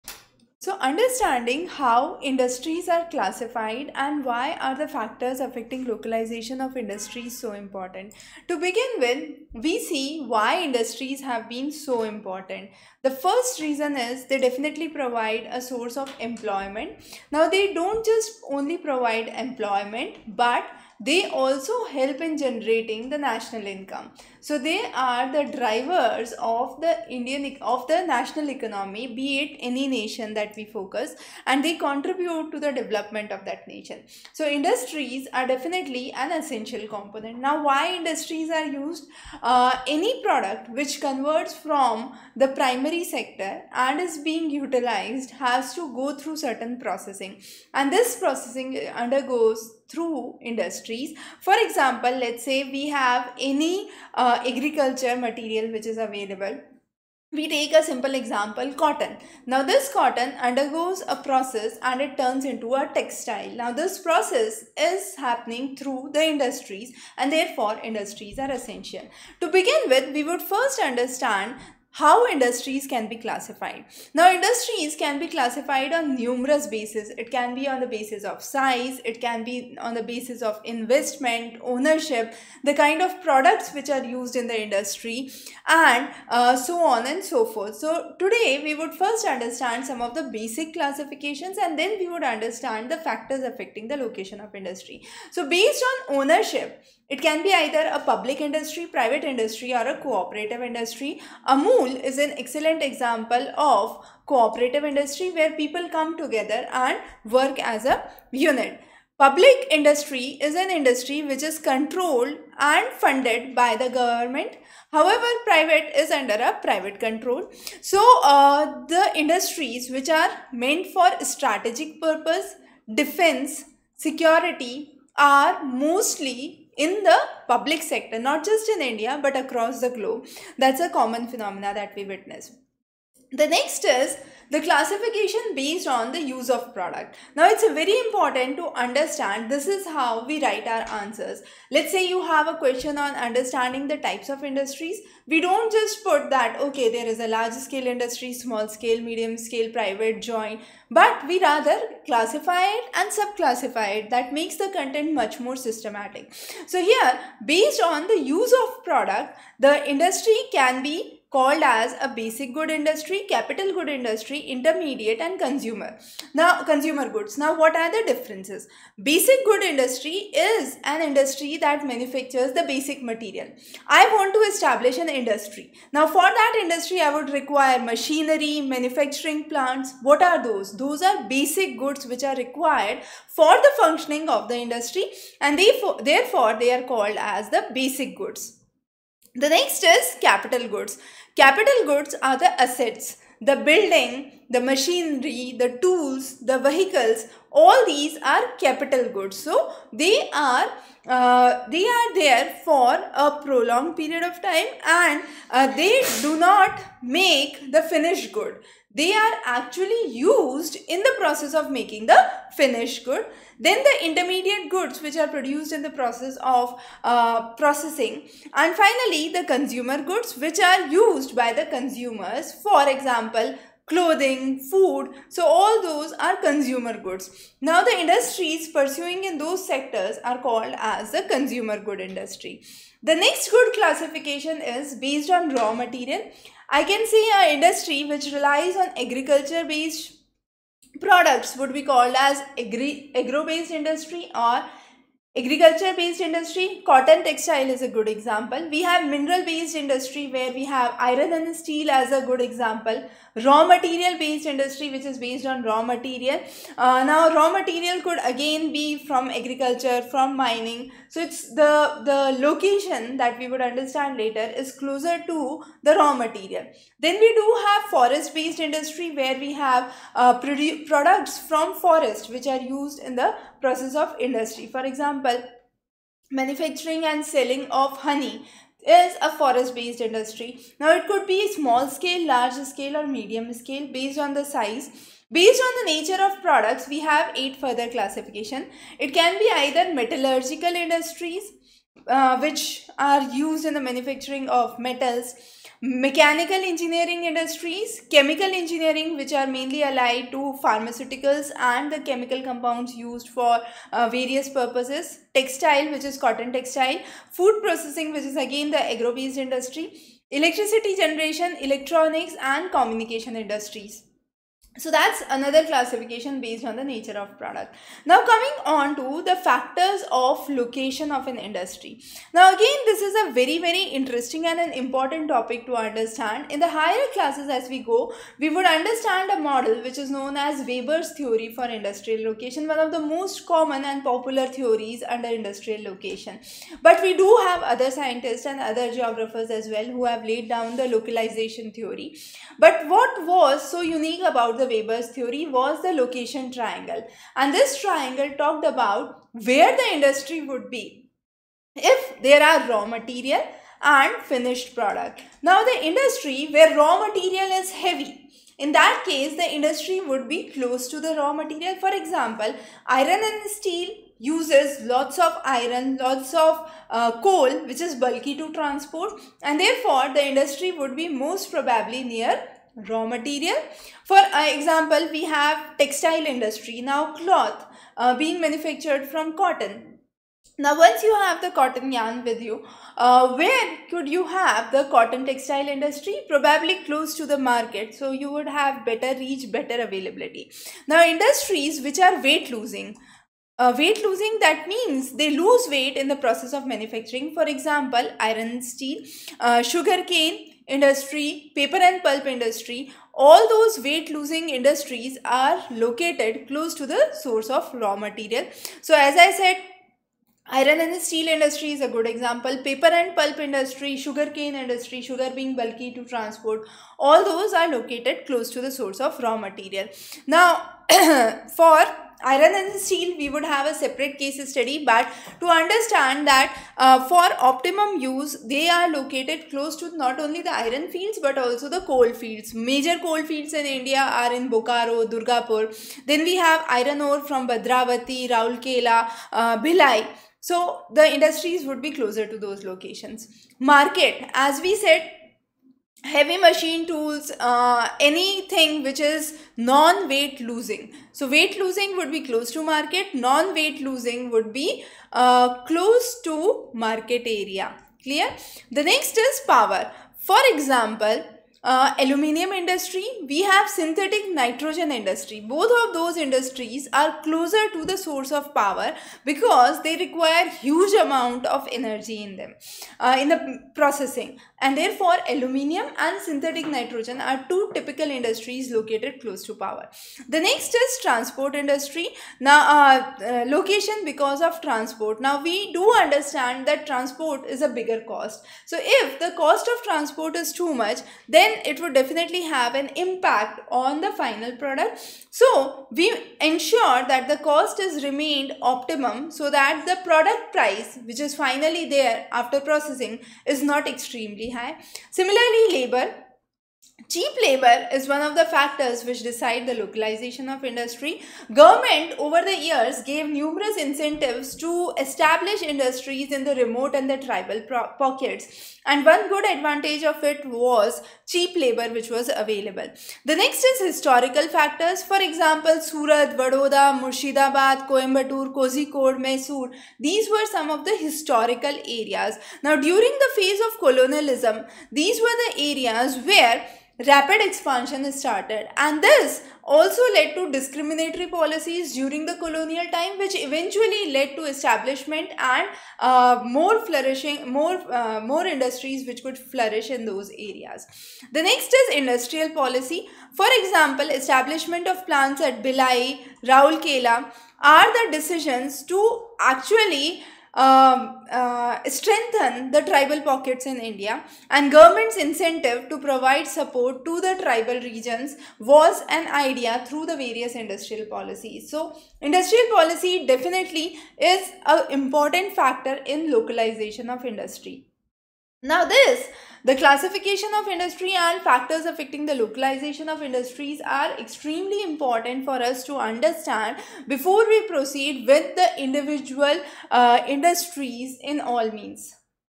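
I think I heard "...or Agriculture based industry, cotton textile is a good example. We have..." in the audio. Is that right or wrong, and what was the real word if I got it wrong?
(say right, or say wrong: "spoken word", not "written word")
right.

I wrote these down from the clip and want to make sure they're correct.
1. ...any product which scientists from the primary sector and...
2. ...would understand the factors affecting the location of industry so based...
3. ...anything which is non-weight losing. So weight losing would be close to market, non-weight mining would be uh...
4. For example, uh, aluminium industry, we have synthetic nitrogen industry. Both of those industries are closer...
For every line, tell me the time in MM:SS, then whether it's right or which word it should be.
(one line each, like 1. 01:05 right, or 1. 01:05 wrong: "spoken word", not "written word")
1. 00:39 wrong: "converts", not "scientists"
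2. 01:32 right
3. 07:27 wrong: "losing", not "mining"
4. 07:40 right.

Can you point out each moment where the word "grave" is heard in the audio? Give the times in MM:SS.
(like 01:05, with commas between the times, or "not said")
not said.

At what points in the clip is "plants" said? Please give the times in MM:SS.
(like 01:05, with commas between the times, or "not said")
02:59, 09:15.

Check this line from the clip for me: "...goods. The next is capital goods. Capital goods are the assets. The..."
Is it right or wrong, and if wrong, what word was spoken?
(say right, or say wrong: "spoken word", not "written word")
right.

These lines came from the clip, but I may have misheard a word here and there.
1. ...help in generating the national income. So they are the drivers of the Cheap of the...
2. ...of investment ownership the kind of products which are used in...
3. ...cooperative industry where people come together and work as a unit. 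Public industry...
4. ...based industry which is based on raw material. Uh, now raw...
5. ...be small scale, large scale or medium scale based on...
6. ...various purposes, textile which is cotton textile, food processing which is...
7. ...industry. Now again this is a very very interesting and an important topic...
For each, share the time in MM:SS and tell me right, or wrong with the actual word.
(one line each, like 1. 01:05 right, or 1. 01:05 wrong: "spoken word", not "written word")
1. 00:21 wrong: "Indian", not "Cheap"
2. 01:20 right
3. 01:44 right
4. 04:14 right
5. 04:41 right
6. 05:04 right
7. 05:21 right.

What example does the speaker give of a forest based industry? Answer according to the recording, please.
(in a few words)
Honey.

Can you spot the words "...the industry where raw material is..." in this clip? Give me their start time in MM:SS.
05:55.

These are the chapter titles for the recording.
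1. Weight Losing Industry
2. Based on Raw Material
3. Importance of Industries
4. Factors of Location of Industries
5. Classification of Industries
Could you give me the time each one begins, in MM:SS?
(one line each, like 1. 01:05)
1. 06:37
2. 03:56
3. 00:12
4. 05:22
5. 01:13.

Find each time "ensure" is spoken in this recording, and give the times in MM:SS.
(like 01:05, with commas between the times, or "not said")
08:16.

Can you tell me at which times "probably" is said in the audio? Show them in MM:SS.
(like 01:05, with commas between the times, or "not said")
06:11, 06:26.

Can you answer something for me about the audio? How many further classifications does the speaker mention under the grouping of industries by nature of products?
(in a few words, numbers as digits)
8.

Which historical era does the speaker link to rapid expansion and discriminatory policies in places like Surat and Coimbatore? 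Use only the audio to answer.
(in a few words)
Colonialism.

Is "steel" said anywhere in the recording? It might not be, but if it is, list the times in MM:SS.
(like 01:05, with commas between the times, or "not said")
04:11, 06:03, 06:38, 06:51, 07:02.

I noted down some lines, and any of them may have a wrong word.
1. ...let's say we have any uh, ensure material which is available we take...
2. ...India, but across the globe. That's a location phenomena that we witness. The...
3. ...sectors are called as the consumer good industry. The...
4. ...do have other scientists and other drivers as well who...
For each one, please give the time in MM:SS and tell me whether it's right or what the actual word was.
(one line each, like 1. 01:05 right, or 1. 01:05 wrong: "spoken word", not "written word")
1. 00:52 wrong: "agriculture", not "ensure"
2. 02:08 wrong: "common", not "location"
3. 03:49 right
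4. 05:37 wrong: "geographers", not "drivers".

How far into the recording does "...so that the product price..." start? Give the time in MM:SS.
08:19.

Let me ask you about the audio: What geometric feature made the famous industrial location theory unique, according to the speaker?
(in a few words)
Location triangle.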